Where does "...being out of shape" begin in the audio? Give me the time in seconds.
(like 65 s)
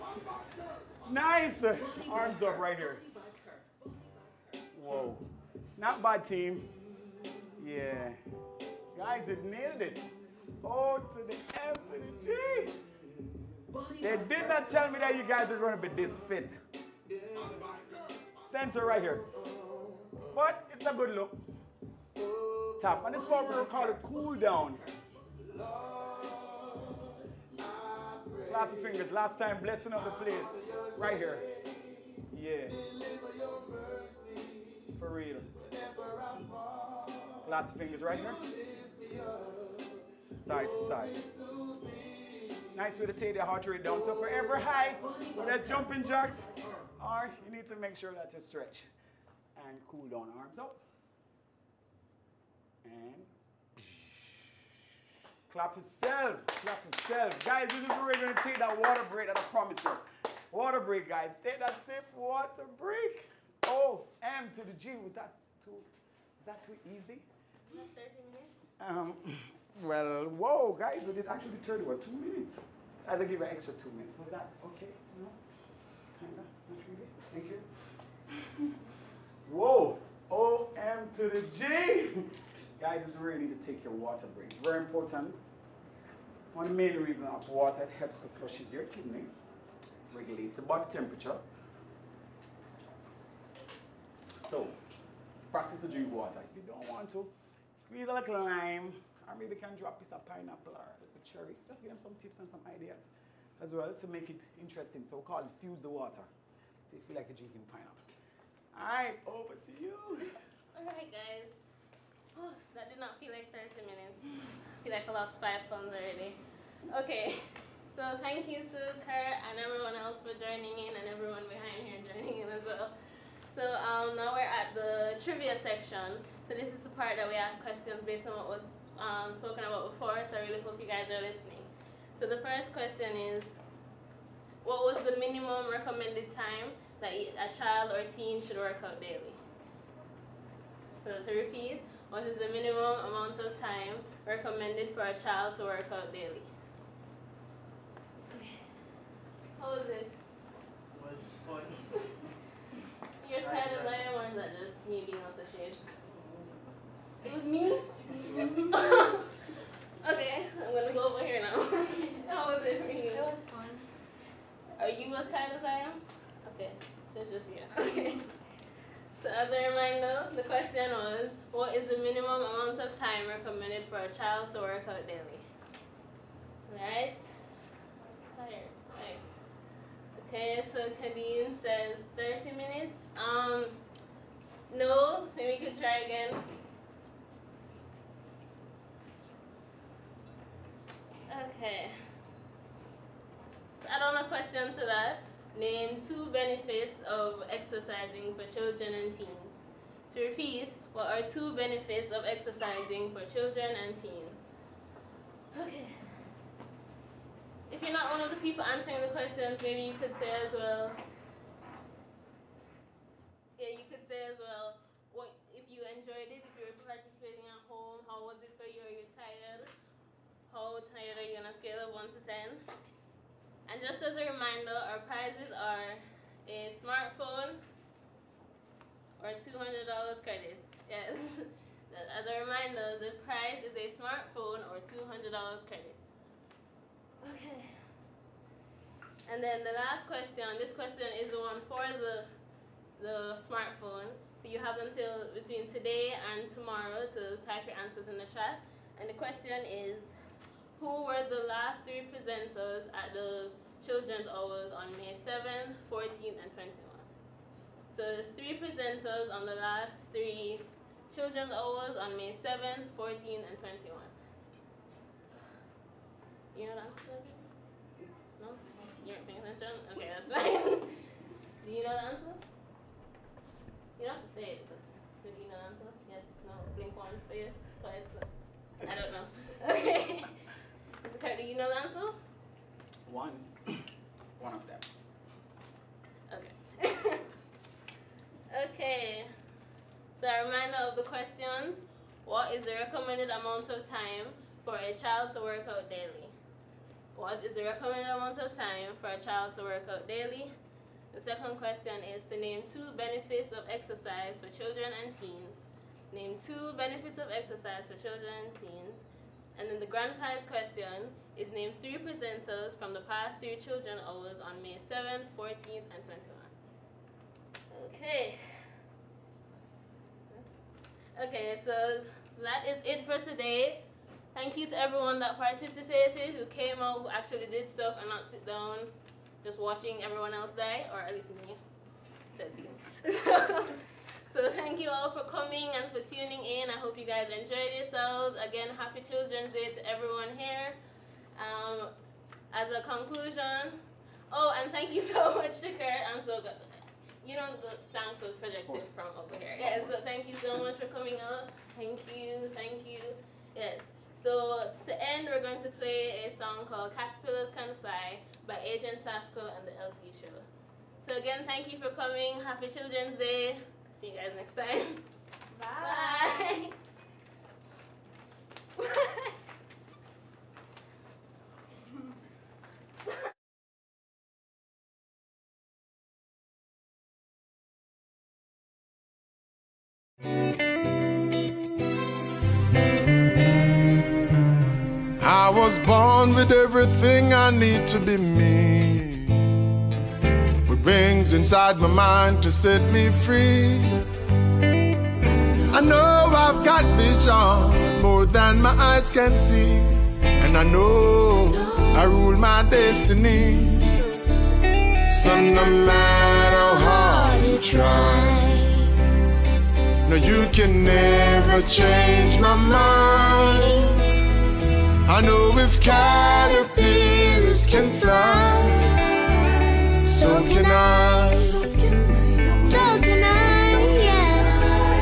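155 s.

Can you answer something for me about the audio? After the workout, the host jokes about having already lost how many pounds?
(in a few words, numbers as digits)
5.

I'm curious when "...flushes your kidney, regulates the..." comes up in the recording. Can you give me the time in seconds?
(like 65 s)
88 s.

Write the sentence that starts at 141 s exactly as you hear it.
So to repeat, what is the minimum amount of time recommended for a child to work out daily?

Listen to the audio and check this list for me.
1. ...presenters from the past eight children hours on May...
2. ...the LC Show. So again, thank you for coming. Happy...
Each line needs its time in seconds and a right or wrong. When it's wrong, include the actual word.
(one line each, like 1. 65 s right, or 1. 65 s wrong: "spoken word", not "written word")
1. 311 s wrong: "three", not "eight"
2. 359 s right.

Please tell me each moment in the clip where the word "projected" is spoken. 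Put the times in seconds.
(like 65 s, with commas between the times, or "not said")
348 s.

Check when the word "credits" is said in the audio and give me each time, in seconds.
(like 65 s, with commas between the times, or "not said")
230 s, 235 s.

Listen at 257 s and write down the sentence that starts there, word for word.
So three presenters on the last three Children's Awards on May 7th, 14th, and 21st.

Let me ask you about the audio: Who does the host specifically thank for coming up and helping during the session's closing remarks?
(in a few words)
Kurt.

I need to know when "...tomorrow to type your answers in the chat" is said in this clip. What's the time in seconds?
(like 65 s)
246 s.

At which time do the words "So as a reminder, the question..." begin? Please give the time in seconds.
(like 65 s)
169 s.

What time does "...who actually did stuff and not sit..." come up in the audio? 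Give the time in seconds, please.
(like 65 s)
327 s.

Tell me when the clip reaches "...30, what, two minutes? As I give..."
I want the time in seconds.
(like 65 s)
71 s.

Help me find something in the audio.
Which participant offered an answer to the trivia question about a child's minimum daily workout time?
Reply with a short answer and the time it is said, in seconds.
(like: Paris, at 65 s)
Kadeen, at 181 s.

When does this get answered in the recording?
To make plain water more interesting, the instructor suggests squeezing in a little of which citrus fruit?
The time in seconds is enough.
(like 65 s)
98 s.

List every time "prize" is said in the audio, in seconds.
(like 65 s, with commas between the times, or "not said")
225 s, 233 s, 310 s.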